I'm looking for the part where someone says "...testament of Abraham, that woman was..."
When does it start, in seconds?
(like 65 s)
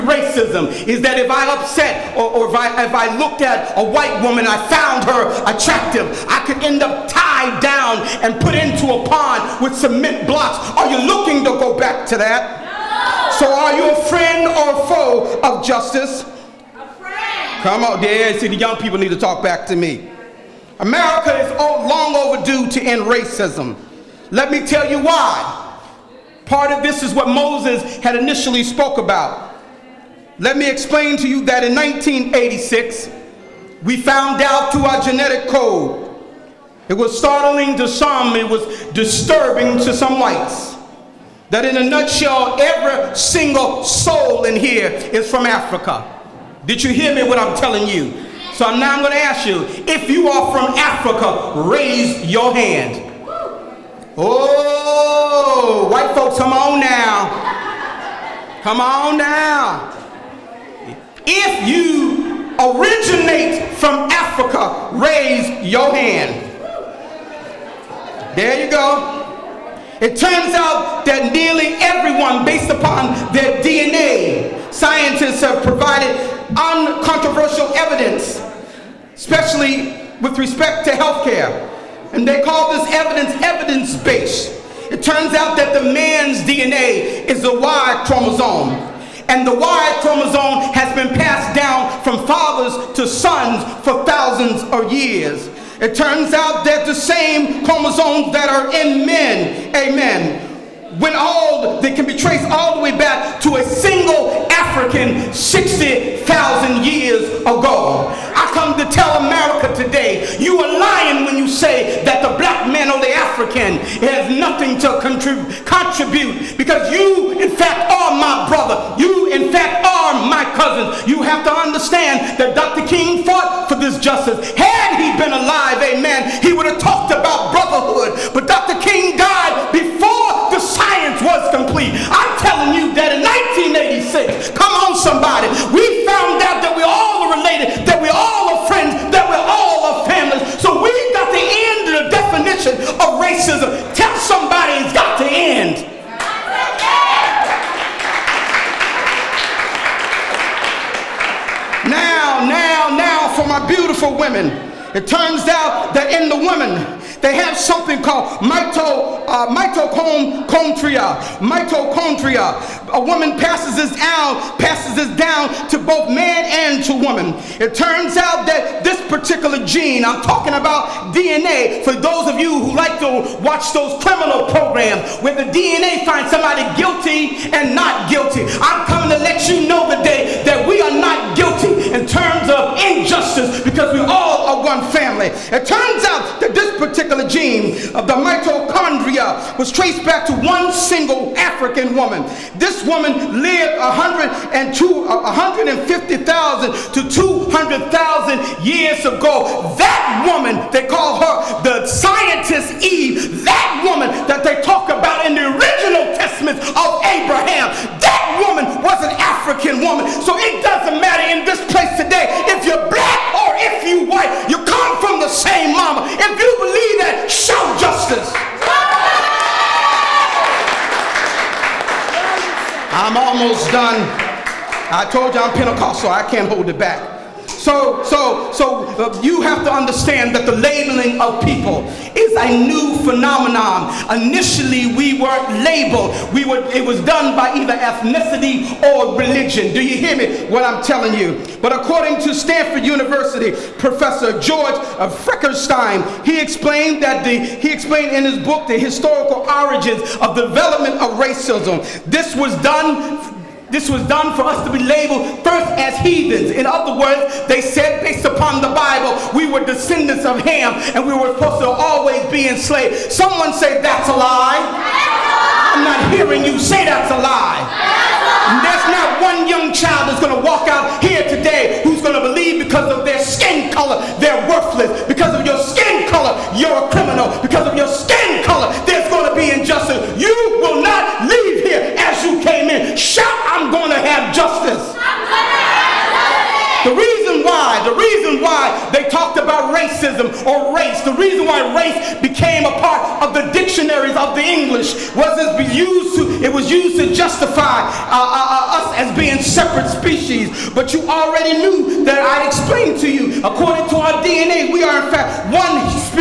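206 s.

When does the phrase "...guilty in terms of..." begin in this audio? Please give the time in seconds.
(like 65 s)
181 s.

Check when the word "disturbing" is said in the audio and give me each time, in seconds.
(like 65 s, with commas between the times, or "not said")
38 s.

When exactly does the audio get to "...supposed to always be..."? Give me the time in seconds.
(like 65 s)
261 s.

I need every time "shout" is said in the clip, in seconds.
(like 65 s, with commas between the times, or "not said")
217 s, 282 s.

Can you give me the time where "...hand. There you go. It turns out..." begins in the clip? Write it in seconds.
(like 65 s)
65 s.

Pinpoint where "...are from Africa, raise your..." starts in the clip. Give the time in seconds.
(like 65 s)
50 s.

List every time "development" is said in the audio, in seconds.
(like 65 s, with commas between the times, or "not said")
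250 s.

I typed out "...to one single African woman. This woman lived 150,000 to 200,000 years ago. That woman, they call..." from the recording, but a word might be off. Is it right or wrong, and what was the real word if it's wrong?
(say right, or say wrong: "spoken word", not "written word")
right.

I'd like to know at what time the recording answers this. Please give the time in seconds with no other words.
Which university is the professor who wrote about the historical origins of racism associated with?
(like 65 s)
242 s.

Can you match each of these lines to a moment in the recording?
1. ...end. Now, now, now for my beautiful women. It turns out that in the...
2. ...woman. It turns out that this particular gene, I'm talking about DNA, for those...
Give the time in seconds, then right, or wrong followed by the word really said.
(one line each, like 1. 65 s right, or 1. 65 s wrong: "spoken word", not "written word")
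1. 145 s right
2. 166 s right.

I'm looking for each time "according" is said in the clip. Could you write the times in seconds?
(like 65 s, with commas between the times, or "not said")
241 s, 303 s.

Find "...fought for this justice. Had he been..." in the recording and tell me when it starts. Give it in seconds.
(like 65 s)
123 s.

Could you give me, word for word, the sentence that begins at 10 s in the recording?
Are you looking to go back to that?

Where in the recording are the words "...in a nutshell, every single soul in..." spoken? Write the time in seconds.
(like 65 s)
41 s.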